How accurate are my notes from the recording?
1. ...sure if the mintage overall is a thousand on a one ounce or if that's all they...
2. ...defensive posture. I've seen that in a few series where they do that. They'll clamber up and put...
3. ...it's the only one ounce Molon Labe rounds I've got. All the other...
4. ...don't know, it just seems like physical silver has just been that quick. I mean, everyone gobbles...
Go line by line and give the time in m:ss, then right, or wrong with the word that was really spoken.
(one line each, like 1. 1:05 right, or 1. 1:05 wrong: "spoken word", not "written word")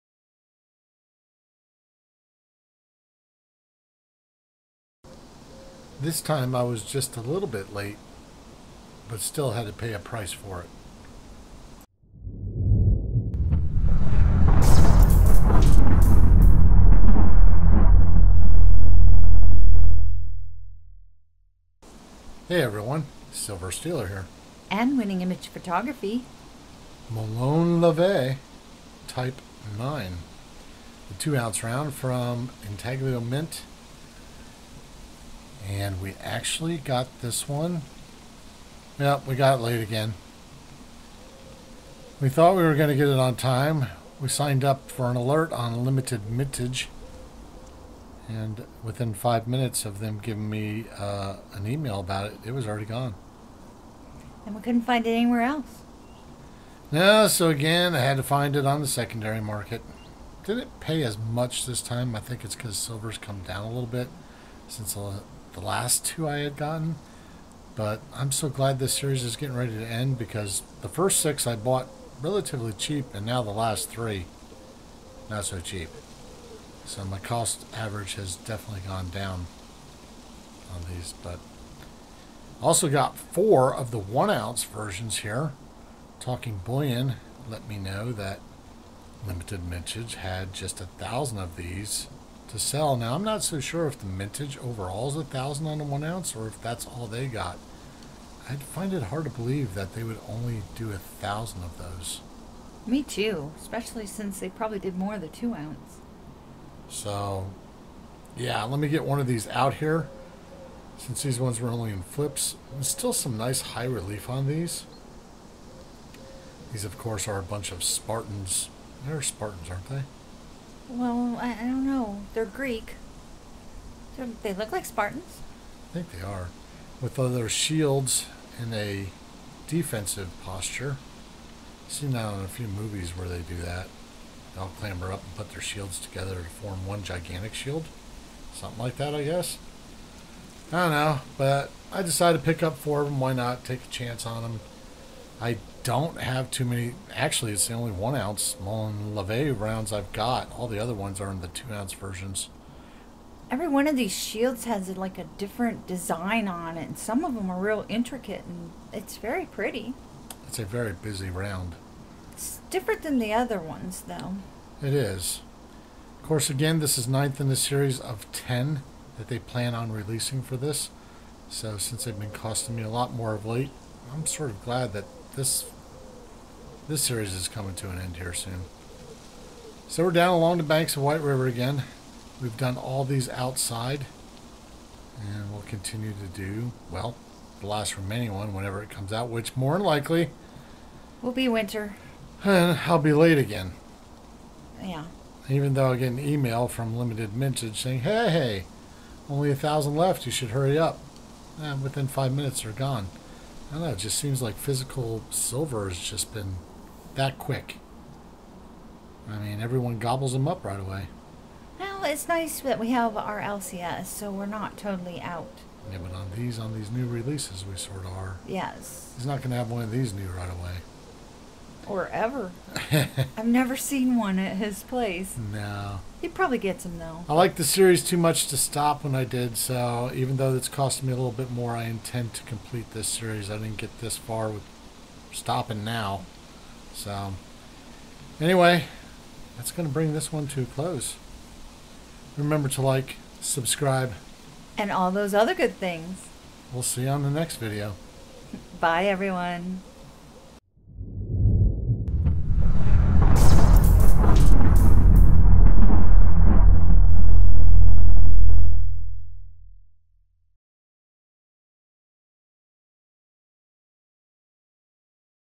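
1. 1:33 right
2. 2:09 wrong: "movies", not "series"
3. 2:27 right
4. 3:23 right.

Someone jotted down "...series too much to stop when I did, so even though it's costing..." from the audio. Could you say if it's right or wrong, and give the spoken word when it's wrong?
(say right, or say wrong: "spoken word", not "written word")
right.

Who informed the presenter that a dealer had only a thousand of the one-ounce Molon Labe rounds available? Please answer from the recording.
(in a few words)
Talking Bullion.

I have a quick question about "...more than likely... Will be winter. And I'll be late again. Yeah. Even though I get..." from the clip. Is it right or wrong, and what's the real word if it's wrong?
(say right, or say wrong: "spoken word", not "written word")
right.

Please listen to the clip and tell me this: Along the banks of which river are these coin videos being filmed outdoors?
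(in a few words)
White River.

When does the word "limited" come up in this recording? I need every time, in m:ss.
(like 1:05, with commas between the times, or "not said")
0:45, 1:29, 3:16.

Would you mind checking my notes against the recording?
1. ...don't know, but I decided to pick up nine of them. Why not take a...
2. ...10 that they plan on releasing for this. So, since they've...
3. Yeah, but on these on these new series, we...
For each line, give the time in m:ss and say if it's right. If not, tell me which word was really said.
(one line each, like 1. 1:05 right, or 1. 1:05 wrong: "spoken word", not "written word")
1. 2:20 wrong: "four", not "nine"
2. 2:48 right
3. 3:35 wrong: "releases", not "series".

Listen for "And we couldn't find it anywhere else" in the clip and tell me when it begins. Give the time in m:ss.
0:54.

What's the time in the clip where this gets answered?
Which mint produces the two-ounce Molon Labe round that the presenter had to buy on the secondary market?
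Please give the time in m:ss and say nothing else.
0:32.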